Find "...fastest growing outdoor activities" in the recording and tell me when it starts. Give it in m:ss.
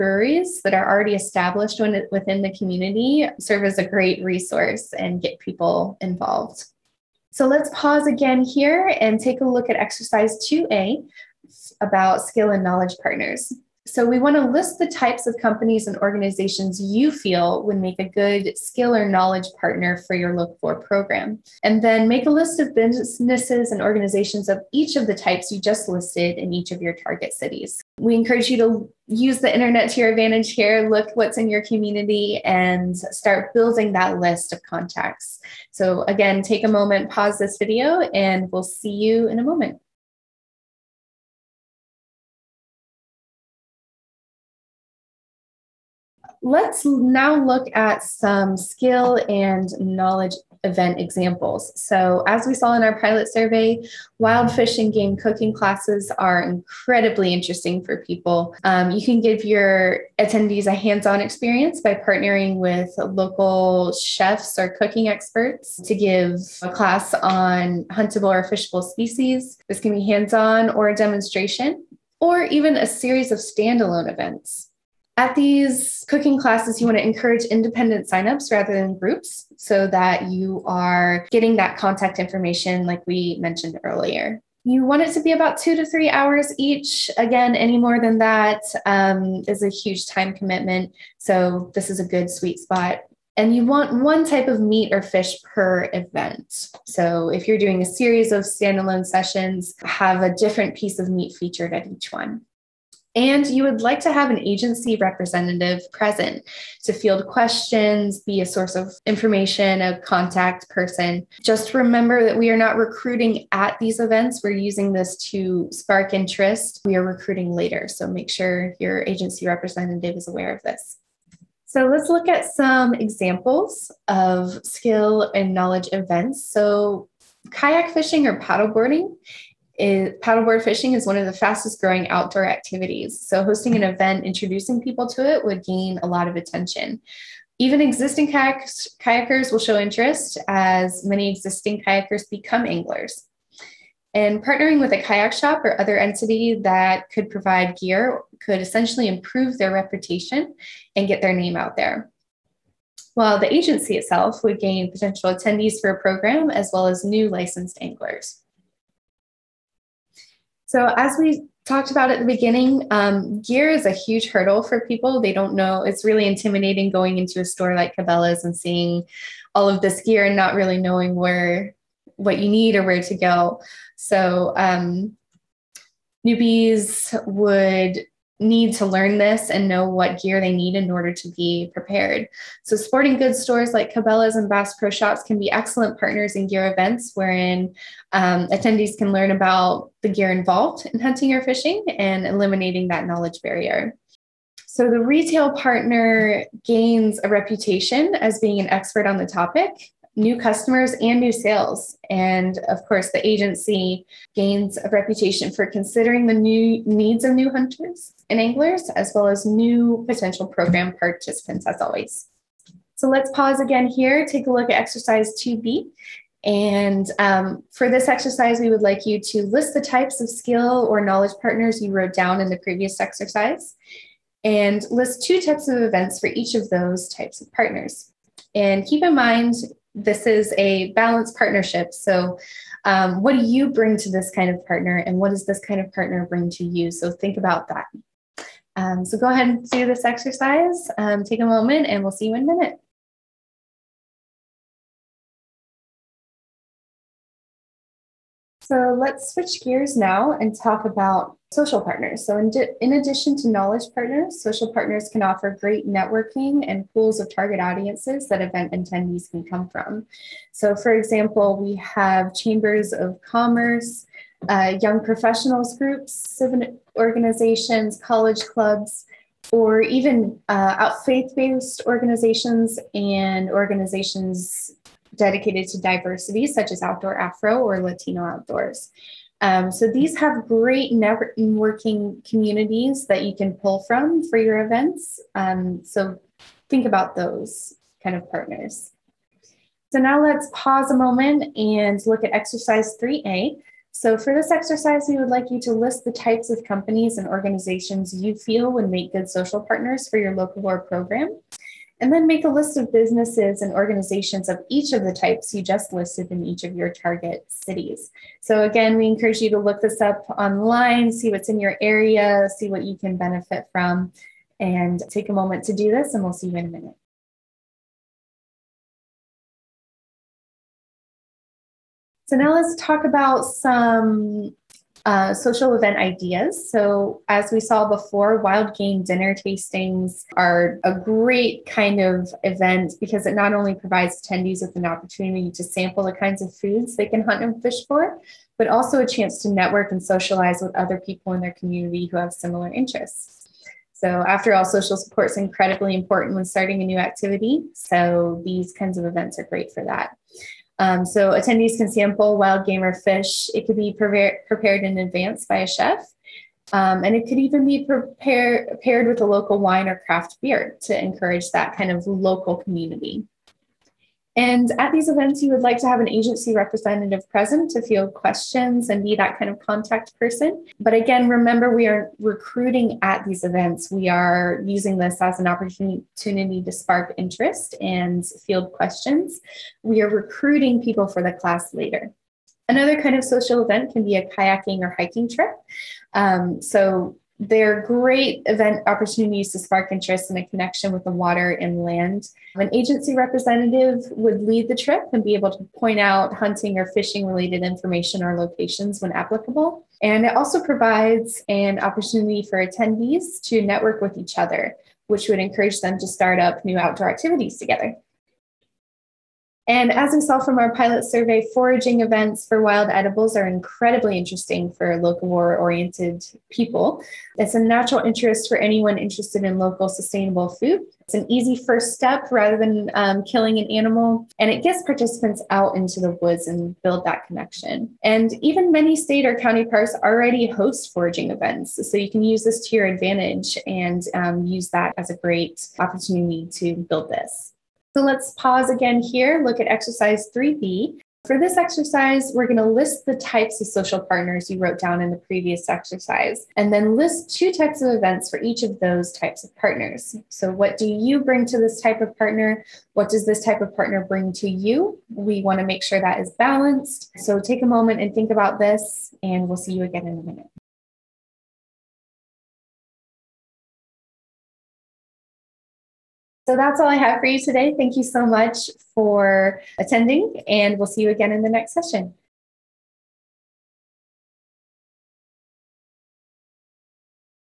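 2:11.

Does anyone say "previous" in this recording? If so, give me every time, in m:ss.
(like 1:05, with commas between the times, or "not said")
3:42, 7:25.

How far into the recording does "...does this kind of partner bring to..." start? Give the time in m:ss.
3:55.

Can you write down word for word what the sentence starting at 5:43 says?
So, after all, social support is incredibly important when starting a new activity.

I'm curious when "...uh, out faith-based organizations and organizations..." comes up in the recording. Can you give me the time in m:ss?
4:30.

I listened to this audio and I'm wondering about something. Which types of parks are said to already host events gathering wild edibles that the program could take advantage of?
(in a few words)
State or county parks.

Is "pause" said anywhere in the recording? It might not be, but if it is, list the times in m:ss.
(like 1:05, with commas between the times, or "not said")
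0:07, 0:37, 3:33, 4:50, 7:18.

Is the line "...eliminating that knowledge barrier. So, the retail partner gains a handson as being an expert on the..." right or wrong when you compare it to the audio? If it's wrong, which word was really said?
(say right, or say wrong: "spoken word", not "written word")
wrong: "reputation", not "handson".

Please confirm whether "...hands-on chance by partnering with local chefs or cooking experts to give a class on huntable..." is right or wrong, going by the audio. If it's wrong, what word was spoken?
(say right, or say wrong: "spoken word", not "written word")
wrong: "experience", not "chance".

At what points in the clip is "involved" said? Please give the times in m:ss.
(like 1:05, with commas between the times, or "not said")
0:06, 3:10.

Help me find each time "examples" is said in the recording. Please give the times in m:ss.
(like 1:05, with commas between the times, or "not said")
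0:50, 2:02, 4:20.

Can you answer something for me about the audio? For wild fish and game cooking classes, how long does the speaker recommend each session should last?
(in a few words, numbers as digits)
2 to 3 hours.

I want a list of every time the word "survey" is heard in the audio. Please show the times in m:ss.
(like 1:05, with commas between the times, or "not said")
0:53, 6:51.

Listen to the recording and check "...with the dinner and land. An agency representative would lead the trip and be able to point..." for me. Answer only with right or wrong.
wrong.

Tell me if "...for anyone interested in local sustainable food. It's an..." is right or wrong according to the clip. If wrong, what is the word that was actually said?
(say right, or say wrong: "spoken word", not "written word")
right.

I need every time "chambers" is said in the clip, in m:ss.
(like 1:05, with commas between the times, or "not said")
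4:22.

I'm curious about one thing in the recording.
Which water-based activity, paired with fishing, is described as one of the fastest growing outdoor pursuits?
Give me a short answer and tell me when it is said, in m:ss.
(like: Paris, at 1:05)
Kayak fishing, at 2:07.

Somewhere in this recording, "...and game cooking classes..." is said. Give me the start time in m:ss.
0:54.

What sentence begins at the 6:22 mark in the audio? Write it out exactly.
Another kind of social event can be a kayaking or hiking trip.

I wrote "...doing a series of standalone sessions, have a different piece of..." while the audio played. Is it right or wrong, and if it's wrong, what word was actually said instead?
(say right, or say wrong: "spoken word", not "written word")
right.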